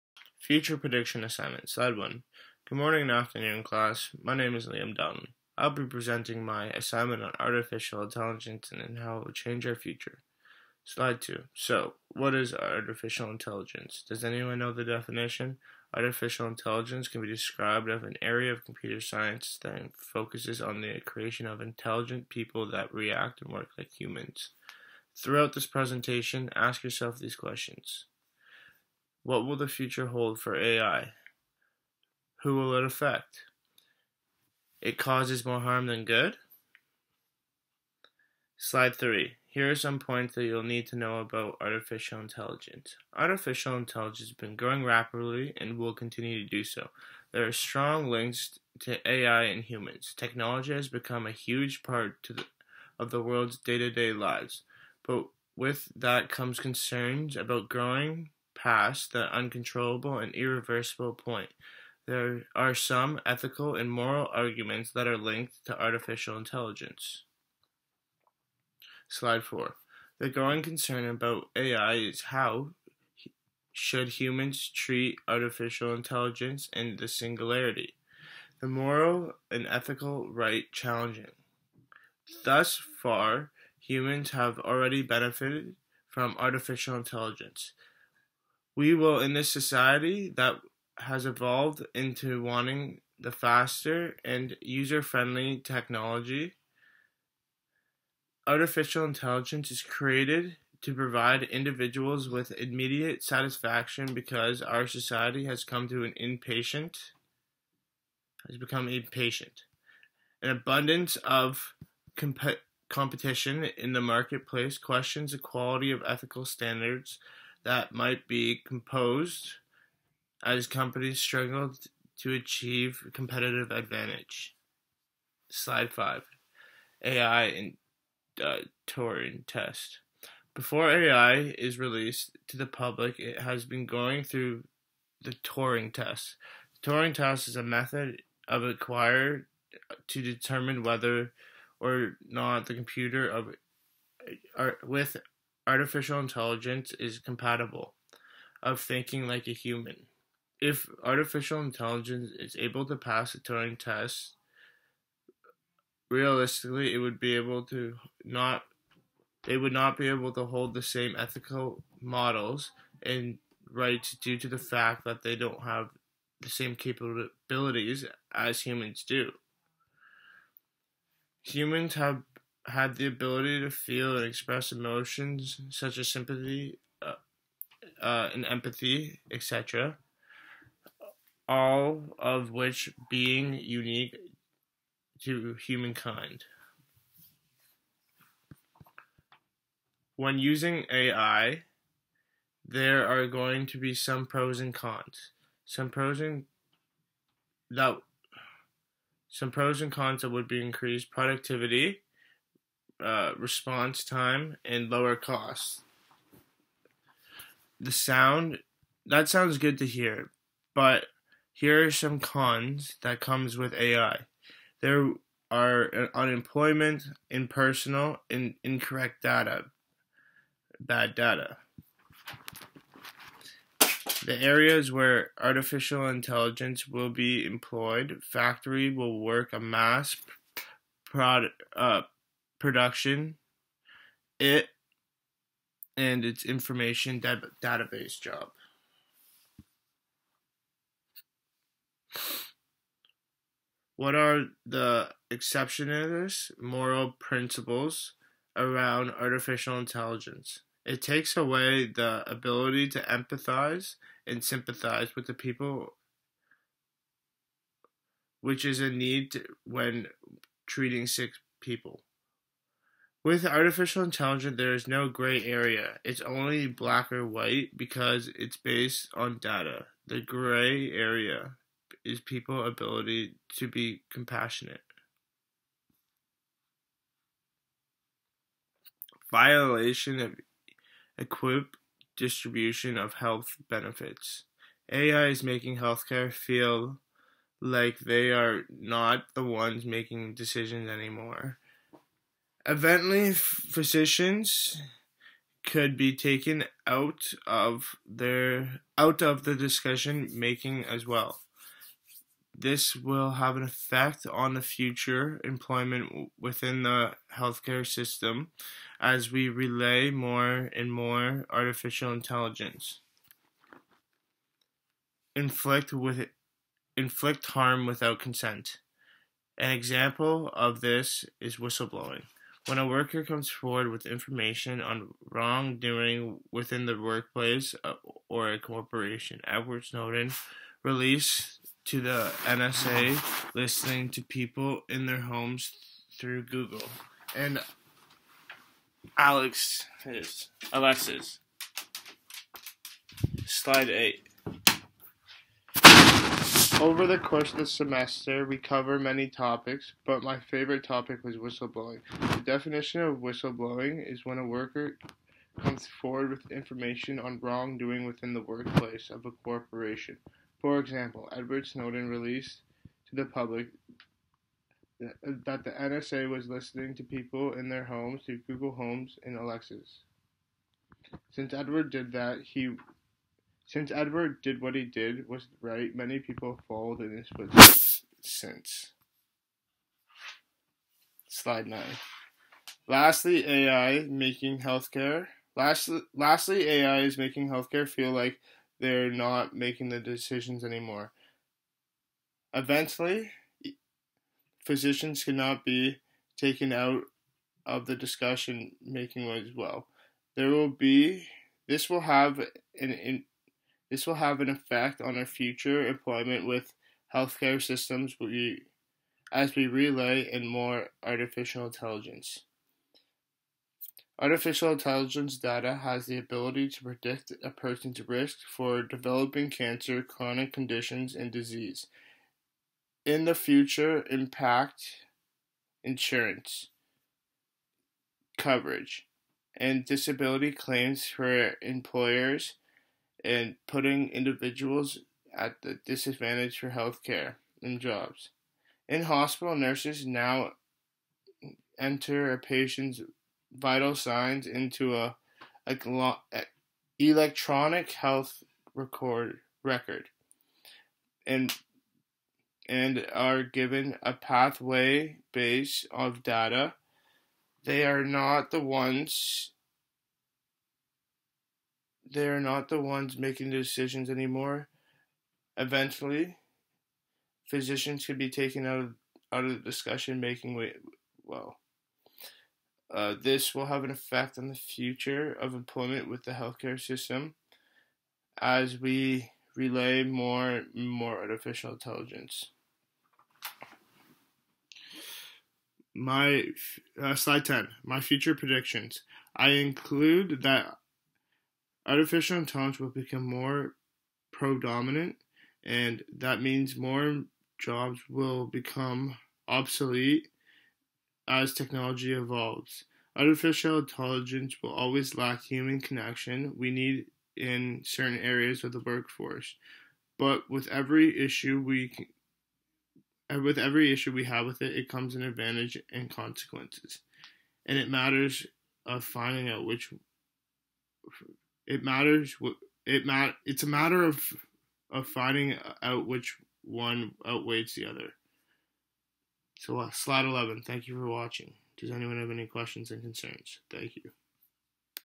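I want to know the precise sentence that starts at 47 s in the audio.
There are strong links to AI and humans.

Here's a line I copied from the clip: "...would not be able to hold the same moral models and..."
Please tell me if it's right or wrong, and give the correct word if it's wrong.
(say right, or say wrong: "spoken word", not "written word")
wrong: "ethical", not "moral".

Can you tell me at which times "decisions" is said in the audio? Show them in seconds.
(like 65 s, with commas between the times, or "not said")
290 s, 390 s, 463 s.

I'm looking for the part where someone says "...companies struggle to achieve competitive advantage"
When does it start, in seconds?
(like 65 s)
120 s.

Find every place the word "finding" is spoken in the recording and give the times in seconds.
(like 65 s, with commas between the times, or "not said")
519 s, 525 s.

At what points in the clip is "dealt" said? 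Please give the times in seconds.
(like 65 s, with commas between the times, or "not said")
not said.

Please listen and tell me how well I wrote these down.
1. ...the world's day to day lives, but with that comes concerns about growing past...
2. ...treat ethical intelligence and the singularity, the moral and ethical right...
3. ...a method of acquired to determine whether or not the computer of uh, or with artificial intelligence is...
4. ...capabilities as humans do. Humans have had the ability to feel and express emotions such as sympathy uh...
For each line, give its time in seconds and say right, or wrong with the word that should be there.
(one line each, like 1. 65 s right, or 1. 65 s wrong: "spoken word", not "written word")
1. 53 s right
2. 74 s wrong: "artificial", not "ethical"
3. 137 s right
4. 166 s right.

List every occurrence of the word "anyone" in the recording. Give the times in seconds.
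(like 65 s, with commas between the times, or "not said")
14 s, 531 s.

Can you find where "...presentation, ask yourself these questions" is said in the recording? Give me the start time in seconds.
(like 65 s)
25 s.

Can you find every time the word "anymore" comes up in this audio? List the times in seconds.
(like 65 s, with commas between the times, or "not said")
290 s, 390 s, 464 s.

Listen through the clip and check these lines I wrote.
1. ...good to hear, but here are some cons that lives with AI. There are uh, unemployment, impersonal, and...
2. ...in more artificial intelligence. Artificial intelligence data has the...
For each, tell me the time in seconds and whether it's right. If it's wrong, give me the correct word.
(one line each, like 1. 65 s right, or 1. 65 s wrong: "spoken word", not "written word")
1. 209 s wrong: "comes", not "lives"
2. 410 s right.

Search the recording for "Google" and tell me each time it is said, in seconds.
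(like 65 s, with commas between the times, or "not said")
336 s, 368 s.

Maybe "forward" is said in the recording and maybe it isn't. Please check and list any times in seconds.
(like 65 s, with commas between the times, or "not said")
323 s, 355 s.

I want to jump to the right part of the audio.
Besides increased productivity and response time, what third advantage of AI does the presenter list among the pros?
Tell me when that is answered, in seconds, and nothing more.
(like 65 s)
204 s.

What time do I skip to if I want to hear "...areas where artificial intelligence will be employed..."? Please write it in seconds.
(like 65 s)
224 s.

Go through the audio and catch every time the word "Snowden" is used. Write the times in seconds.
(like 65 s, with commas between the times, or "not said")
329 s, 361 s.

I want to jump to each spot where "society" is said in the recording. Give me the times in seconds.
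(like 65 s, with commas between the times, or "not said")
89 s, 104 s.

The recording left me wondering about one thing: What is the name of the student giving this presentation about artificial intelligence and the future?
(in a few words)
Liam Dunn.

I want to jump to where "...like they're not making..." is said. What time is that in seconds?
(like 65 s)
388 s.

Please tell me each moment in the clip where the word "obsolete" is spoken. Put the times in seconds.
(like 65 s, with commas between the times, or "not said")
499 s.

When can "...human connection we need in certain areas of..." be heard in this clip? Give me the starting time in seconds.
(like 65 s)
505 s.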